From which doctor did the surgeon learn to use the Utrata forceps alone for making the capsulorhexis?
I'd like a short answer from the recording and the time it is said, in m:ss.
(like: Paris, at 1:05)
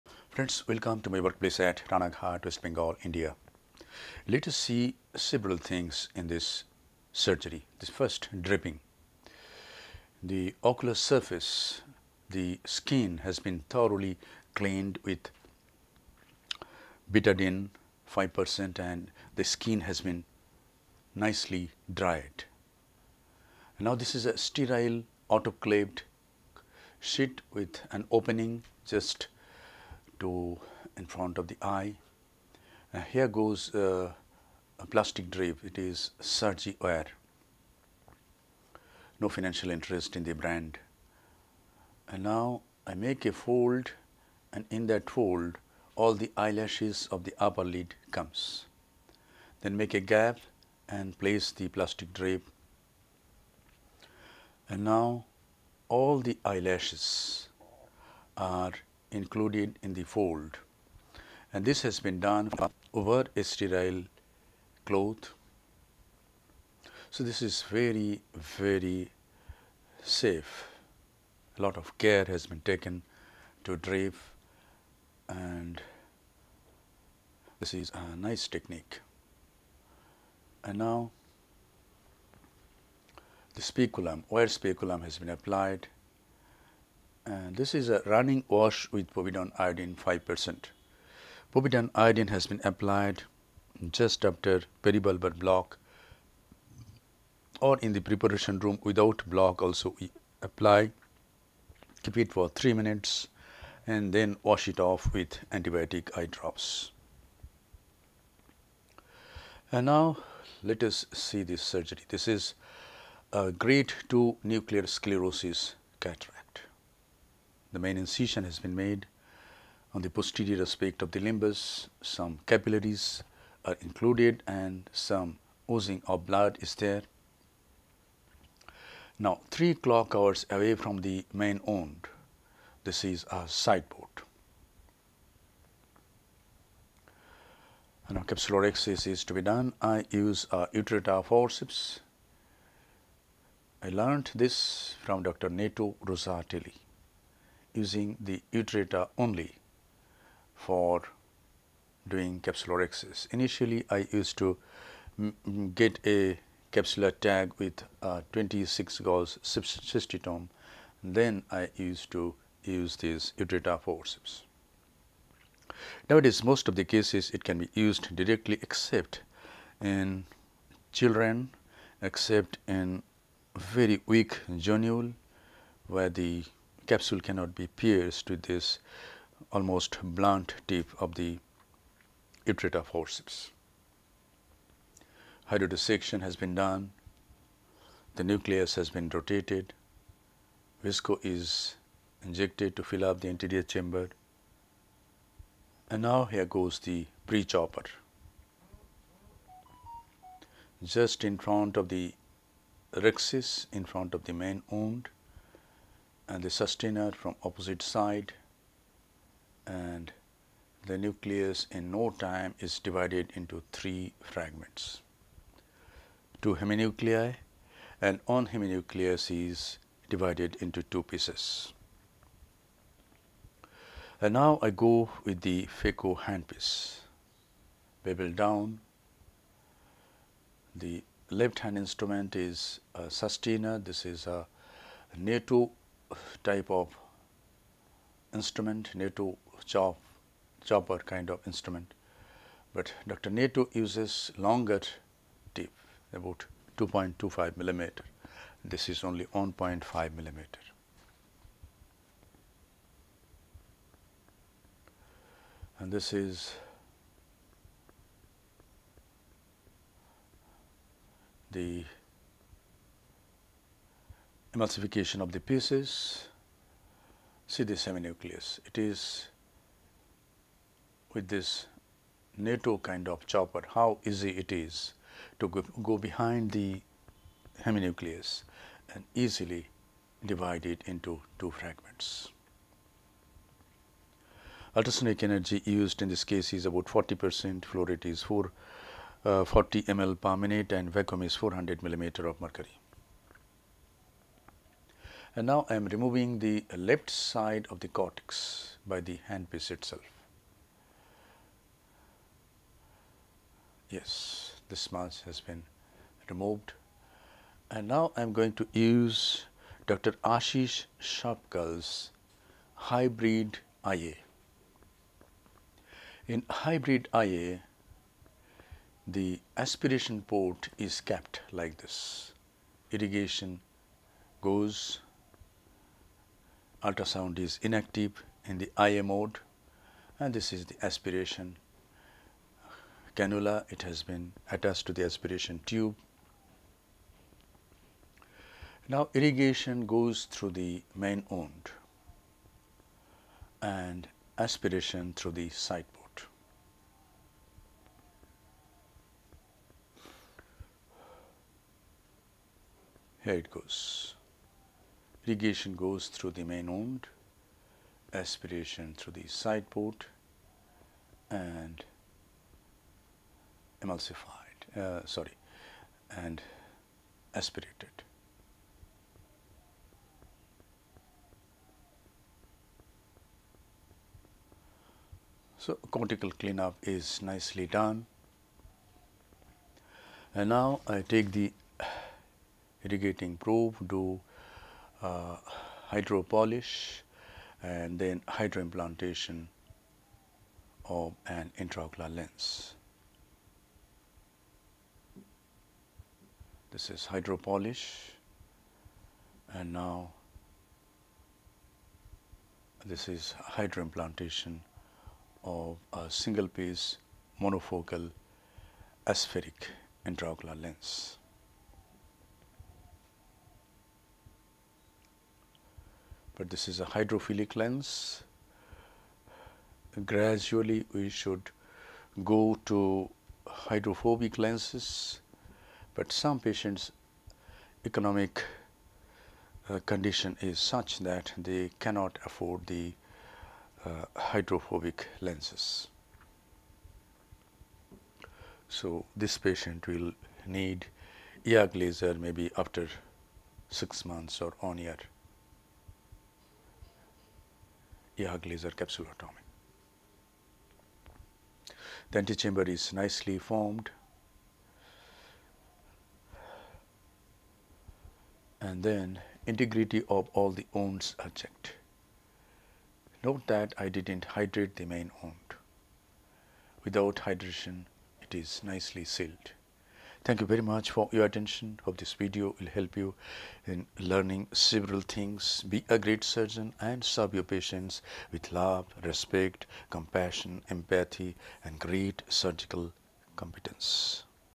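Dr. Neto Rosatelli, at 2:25.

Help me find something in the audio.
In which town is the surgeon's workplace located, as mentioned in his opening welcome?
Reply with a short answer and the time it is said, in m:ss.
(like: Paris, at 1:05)
Ranaghat, at 0:01.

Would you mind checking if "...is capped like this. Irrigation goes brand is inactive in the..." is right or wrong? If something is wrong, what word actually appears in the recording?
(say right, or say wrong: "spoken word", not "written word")
wrong: "ultrasound", not "brand".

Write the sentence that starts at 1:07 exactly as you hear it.
So, this is very very safe a lot of care has been taken to drape and this is a nice technique.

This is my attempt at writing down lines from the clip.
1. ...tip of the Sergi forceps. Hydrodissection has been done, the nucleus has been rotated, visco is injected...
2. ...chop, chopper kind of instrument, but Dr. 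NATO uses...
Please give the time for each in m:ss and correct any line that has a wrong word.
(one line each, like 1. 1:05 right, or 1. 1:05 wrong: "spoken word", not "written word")
1. 3:00 wrong: "Utrata", not "Sergi"
2. 3:59 right.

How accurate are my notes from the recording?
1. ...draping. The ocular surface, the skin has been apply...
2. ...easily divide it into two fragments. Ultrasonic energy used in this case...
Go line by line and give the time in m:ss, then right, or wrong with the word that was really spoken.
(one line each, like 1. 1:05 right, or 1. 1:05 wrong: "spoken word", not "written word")
1. 0:08 wrong: "thoroughly", not "apply"
2. 4:39 right.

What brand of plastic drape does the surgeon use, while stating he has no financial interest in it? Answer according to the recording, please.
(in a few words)
Sergi Ware.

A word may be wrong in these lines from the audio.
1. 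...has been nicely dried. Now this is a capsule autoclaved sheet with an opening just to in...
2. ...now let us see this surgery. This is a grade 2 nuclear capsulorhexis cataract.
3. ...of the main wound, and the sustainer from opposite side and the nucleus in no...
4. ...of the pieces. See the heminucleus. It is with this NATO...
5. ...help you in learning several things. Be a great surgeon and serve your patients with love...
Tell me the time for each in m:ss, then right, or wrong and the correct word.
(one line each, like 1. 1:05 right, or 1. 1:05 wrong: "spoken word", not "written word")
1. 0:19 wrong: "sterile", not "capsule"
2. 1:49 wrong: "sclerosis", not "capsulorhexis"
3. 3:24 right
4. 4:25 right
5. 7:52 right.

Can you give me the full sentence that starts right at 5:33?
It has been attached to the aspiration tube.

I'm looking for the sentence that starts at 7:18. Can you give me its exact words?
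So, this patient will need YAG laser maybe after 6 months or on year.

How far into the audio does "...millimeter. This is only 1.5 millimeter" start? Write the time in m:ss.
4:07.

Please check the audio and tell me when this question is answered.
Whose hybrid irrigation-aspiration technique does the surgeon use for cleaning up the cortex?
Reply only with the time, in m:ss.
5:09.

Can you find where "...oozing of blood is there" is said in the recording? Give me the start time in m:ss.
2:05.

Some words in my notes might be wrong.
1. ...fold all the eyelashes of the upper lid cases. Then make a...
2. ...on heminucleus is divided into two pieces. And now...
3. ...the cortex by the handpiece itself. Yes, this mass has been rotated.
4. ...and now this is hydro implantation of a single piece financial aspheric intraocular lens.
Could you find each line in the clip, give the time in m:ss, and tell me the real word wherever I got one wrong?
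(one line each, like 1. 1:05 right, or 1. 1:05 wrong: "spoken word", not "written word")
1. 0:45 wrong: "comes", not "cases"
2. 3:38 right
3. 4:57 wrong: "removed", not "rotated"
4. 6:39 wrong: "monofocal", not "financial".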